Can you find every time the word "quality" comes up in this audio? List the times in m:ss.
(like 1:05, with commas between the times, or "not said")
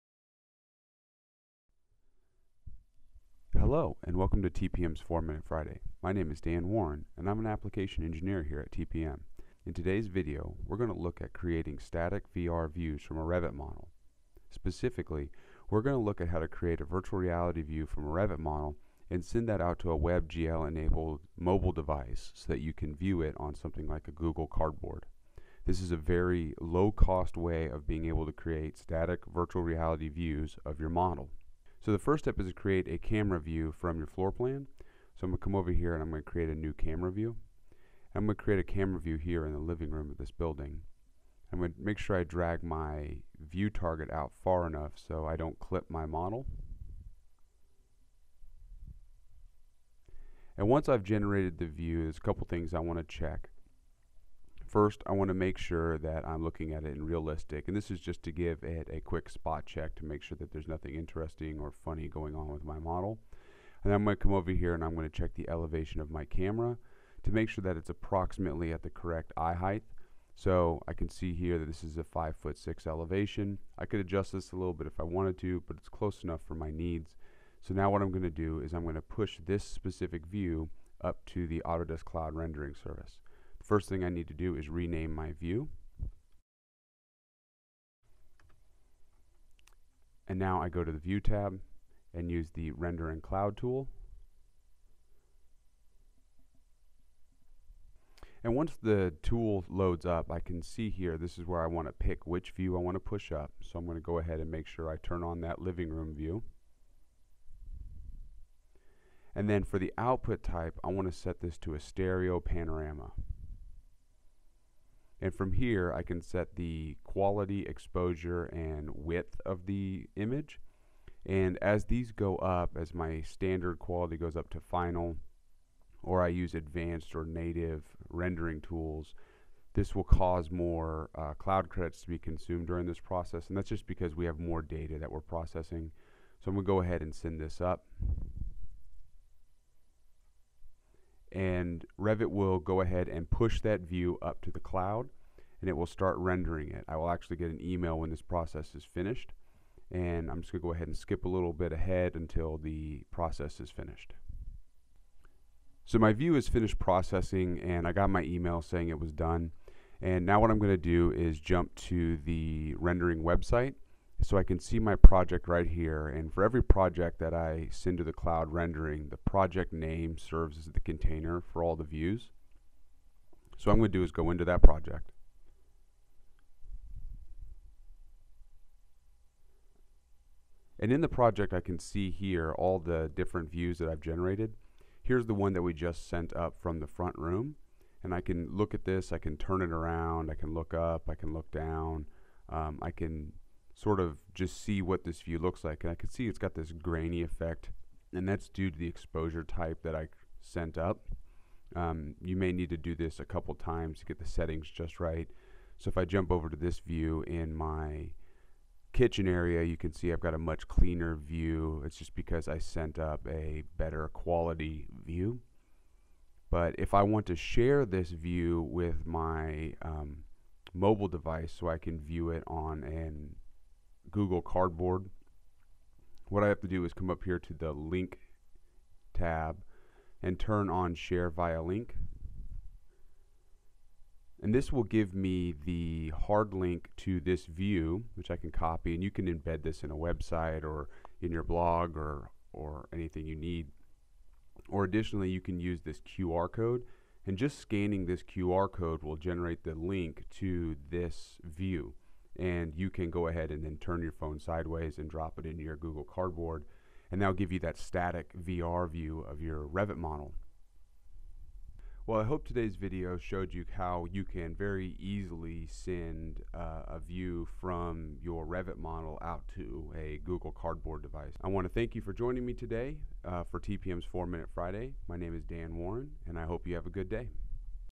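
1:57, 2:03, 3:34.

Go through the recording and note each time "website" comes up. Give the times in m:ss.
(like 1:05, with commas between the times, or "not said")
2:43, 3:59.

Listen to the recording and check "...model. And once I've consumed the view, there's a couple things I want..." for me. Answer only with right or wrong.
wrong.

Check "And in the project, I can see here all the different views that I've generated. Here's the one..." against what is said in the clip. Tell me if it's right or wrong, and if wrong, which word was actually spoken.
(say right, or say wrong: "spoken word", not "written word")
right.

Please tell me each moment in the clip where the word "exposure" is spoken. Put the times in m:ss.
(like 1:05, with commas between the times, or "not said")
1:57, 3:18.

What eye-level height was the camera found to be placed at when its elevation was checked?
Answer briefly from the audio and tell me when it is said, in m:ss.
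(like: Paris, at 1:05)
5 foot 6, at 1:12.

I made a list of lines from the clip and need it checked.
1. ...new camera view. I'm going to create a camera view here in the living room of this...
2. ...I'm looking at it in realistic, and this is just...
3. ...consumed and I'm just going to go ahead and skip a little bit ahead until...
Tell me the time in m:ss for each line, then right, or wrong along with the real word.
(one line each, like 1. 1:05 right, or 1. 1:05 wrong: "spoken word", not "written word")
1. 0:36 right
2. 0:56 right
3. 2:28 wrong: "finished", not "consumed".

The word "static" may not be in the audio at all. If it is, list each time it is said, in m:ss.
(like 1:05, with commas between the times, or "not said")
0:11, 0:28, 4:17.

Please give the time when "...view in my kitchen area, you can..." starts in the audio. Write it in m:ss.
3:26.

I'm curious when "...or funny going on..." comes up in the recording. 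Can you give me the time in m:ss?
1:01.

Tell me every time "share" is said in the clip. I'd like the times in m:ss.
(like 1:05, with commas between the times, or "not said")
3:37, 3:50.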